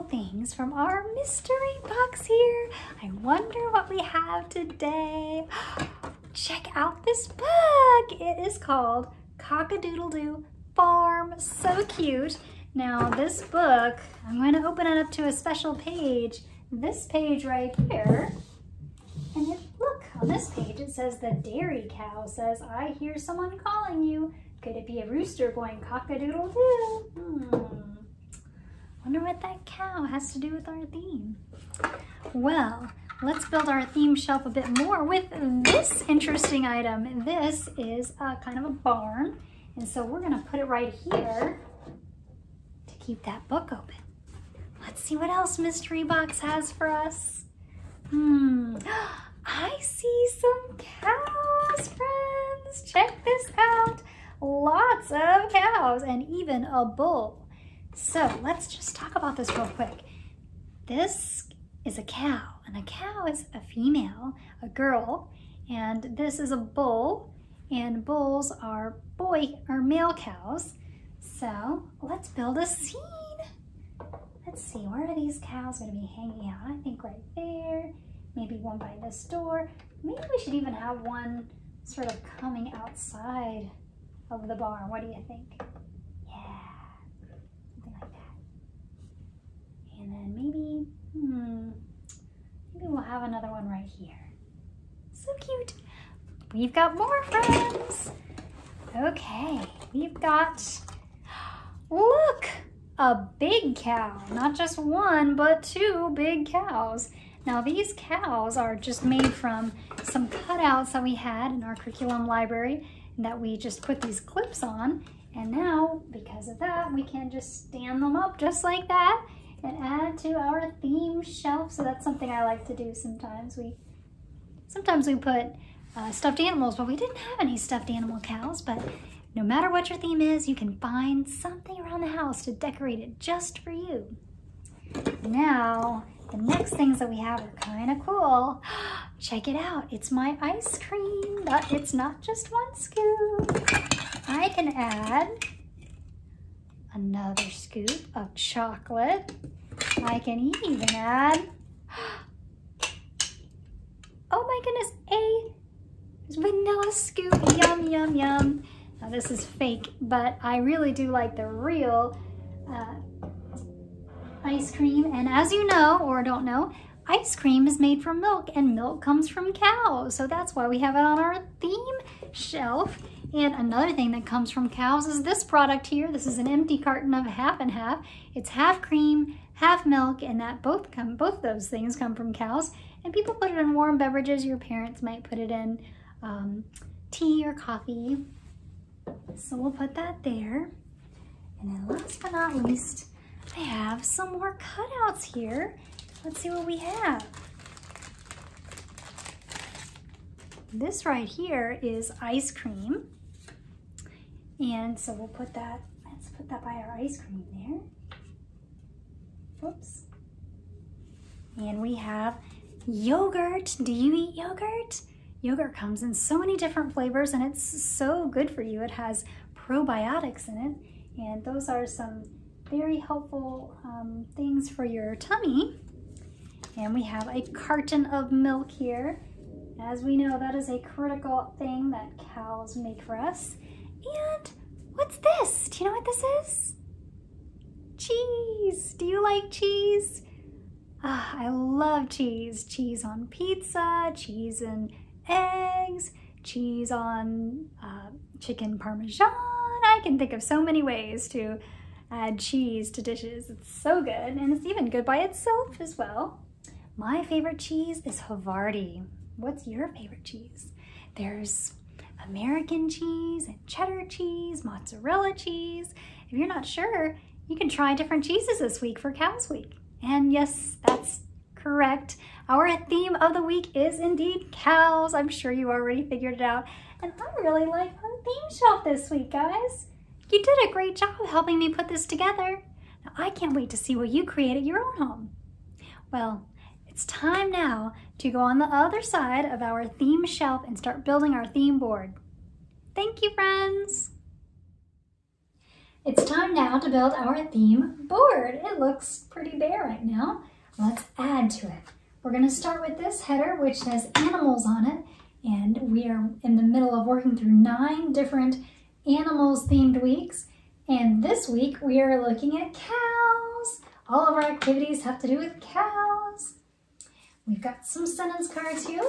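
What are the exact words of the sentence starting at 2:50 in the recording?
So that's why we have it on our theme shelf.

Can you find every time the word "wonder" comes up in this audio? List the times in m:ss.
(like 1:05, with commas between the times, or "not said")
0:03, 0:29.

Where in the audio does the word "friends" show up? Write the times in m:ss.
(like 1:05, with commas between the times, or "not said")
0:51, 1:37, 4:53.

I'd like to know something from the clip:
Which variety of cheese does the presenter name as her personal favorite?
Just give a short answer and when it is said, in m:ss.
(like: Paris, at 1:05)
Havarti, at 4:18.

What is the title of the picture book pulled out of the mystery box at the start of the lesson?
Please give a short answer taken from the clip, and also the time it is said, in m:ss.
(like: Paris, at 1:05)
Cock-a-Doodle-Doo Farm, at 0:09.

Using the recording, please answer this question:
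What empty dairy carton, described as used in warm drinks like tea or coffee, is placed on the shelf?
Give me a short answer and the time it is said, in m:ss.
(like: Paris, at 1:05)
Half and half, at 2:57.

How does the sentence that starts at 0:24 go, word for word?
Could it be a rooster going cock-a-doodle-doo?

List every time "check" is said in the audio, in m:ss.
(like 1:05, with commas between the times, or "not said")
0:06, 0:52, 2:19.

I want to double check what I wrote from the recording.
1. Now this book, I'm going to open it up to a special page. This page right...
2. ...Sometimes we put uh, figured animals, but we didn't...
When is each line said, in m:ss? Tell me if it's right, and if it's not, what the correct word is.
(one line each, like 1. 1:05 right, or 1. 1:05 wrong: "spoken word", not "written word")
1. 0:12 right
2. 2:04 wrong: "stuffed", not "figured".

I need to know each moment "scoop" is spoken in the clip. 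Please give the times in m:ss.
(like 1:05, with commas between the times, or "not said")
2:22, 2:27, 2:36.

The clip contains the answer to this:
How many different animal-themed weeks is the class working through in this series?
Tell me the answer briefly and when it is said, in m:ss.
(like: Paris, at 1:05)
9, at 5:07.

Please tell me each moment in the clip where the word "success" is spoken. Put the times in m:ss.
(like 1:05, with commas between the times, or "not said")
not said.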